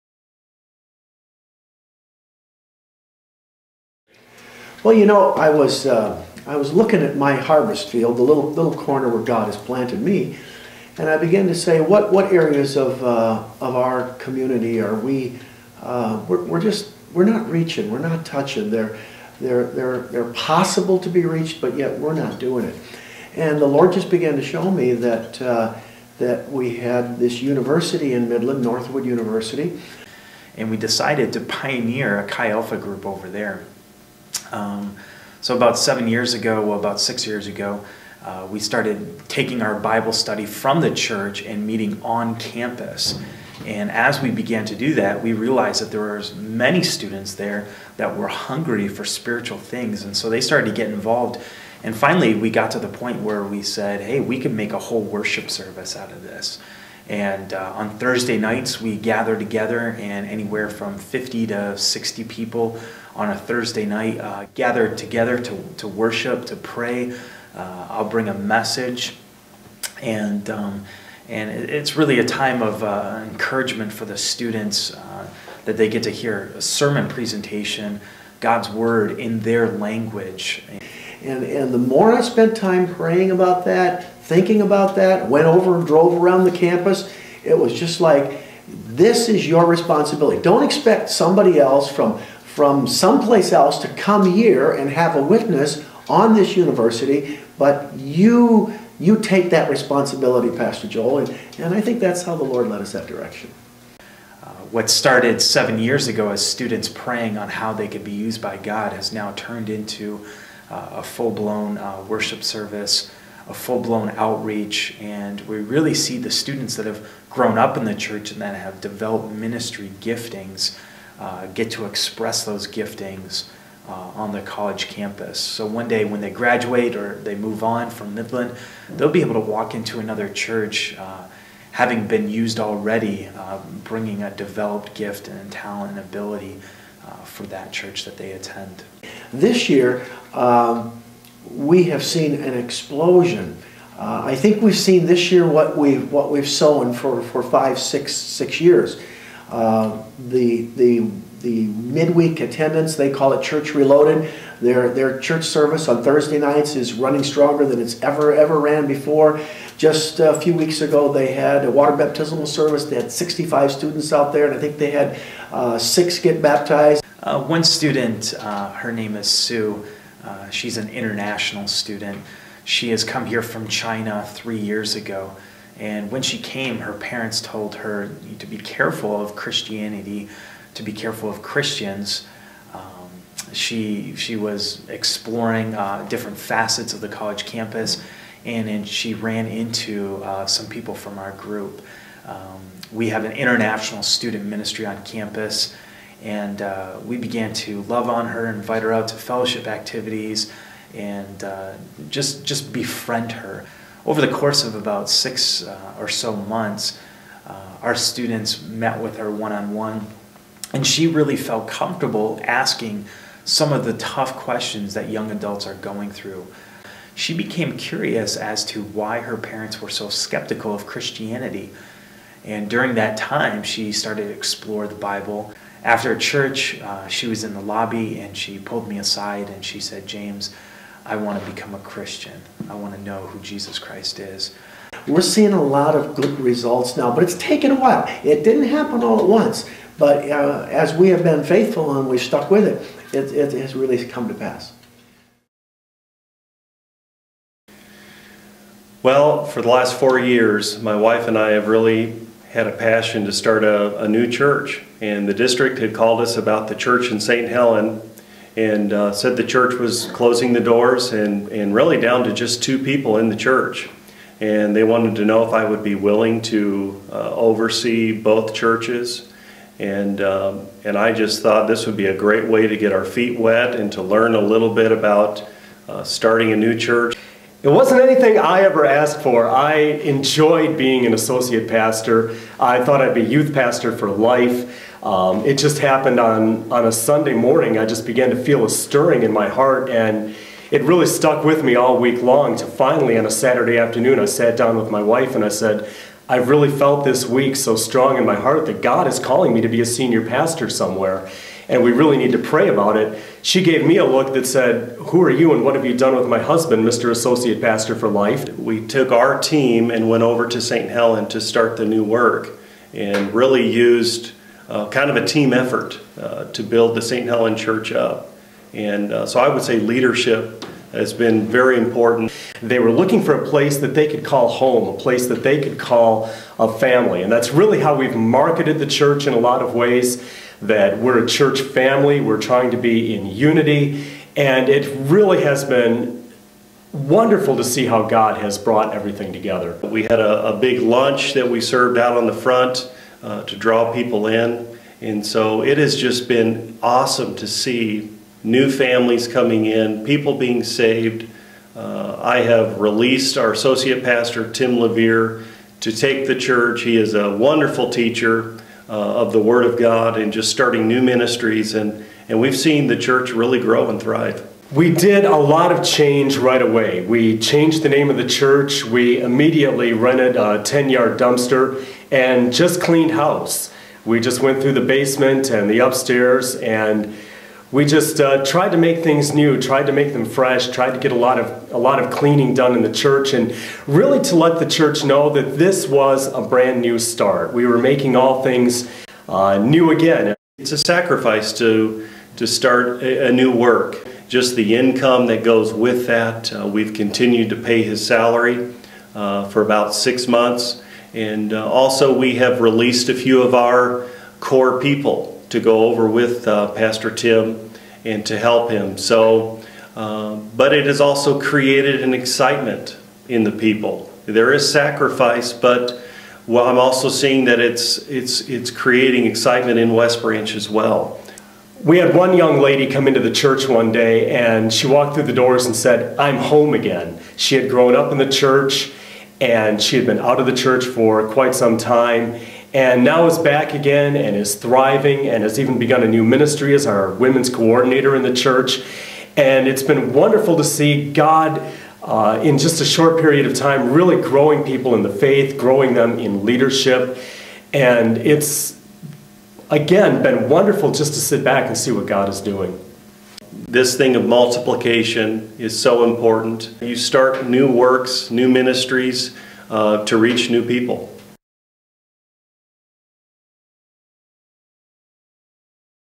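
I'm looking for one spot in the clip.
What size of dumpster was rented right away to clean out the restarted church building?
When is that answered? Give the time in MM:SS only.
06:10.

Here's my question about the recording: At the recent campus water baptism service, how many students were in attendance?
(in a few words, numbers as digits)
65.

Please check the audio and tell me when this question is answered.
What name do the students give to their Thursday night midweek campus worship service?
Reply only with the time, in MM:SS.
02:33.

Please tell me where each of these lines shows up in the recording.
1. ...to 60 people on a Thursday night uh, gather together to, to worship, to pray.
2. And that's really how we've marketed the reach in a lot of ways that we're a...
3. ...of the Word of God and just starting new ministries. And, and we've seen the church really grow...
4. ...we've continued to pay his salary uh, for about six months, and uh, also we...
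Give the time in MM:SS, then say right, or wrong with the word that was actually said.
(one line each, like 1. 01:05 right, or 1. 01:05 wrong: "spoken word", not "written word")
1. 01:01 right
2. 05:27 wrong: "church", not "reach"
3. 05:59 right
4. 06:36 right.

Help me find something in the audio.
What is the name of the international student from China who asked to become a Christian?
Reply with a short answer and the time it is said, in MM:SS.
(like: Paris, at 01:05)
Sue, at 02:49.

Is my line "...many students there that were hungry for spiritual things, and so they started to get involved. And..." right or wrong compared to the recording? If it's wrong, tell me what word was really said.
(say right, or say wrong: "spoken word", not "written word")
right.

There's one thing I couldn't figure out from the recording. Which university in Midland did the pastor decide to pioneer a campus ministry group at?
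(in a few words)
Northwood University.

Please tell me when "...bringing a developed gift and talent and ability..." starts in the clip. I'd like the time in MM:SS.
02:13.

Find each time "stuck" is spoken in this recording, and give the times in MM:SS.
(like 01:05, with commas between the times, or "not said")
04:02, 04:51.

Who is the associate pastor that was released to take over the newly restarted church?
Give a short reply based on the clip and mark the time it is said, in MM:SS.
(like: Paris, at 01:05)
Tim Levere, at 05:54.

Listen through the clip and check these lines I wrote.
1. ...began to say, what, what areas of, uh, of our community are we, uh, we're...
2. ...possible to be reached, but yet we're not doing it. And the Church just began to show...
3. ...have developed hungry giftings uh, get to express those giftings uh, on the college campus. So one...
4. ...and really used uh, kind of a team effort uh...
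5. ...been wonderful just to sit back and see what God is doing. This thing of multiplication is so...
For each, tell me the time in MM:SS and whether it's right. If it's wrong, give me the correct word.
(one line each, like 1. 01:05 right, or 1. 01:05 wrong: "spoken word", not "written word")
1. 00:11 right
2. 00:20 wrong: "Lord", not "Church"
3. 01:58 wrong: "ministry", not "hungry"
4. 05:12 right
5. 07:30 right.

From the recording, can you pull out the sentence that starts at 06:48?
So, uh, but it has also created an excitement in the people.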